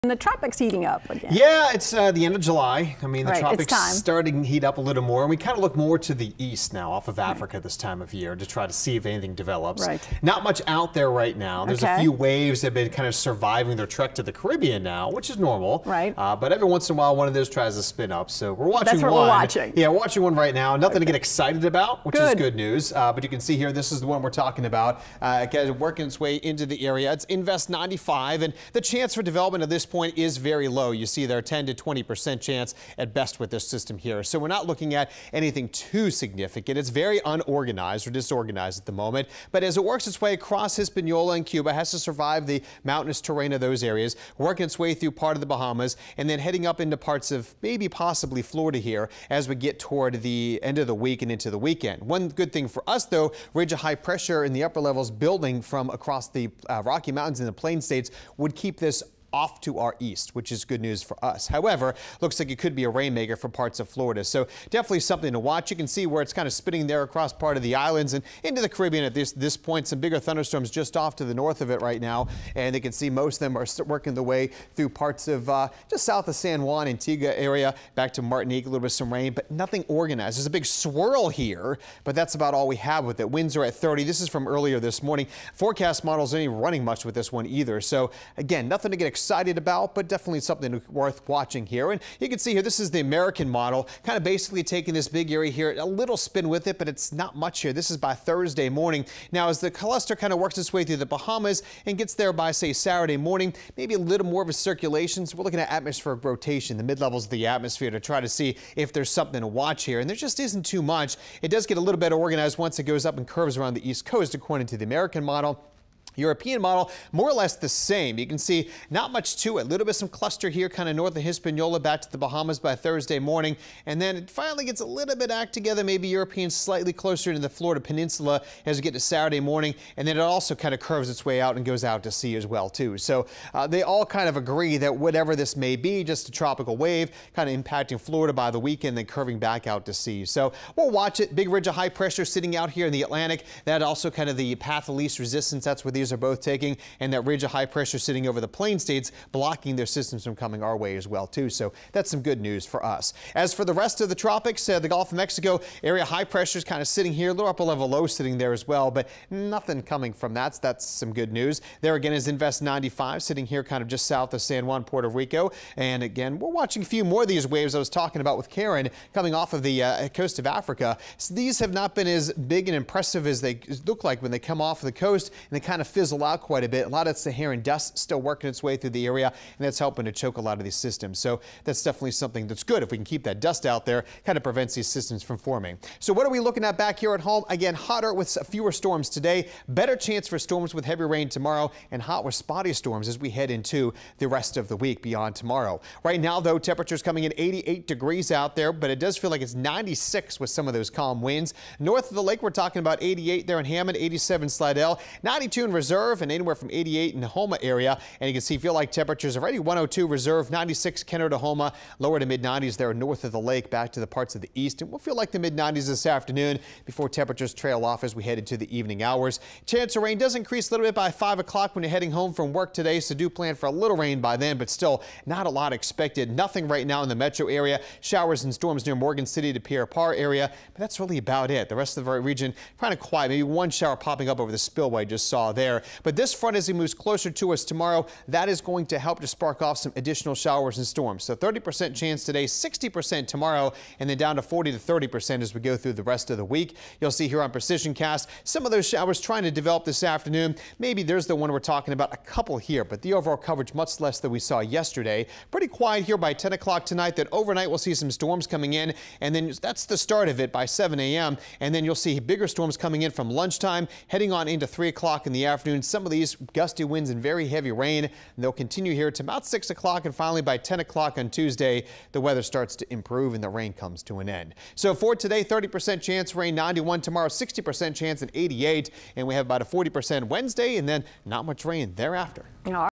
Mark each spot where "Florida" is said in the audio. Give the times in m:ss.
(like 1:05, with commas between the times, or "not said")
0:48, 1:03, 2:07, 2:18.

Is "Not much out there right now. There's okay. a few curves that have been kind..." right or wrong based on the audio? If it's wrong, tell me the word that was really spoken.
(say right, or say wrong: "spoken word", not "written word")
wrong: "waves", not "curves".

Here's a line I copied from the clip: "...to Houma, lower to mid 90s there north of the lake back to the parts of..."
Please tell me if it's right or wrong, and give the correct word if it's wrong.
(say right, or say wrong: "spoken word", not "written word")
right.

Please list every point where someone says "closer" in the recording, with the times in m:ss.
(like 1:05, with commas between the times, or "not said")
2:06, 3:56.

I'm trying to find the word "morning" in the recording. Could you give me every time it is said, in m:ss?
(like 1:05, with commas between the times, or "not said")
1:25, 1:38, 1:43, 2:03, 2:09.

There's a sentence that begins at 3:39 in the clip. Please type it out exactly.
Chance of rain does increase a little bit by 5 o'clock when you're heading home from work today.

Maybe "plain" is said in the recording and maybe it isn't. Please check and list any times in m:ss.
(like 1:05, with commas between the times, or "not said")
0:57, 2:28.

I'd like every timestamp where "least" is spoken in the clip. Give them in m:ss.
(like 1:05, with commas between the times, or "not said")
2:24.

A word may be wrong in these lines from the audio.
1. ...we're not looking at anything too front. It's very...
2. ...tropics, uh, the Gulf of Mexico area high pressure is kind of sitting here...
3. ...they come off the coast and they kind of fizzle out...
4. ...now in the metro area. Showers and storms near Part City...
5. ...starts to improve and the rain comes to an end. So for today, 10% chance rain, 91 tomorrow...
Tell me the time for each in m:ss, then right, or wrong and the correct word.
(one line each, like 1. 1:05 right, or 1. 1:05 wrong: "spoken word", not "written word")
1. 0:34 wrong: "significant", not "front"
2. 2:34 right
3. 2:54 right
4. 3:46 wrong: "Morgan", not "Part"
5. 4:32 wrong: "30", not "10".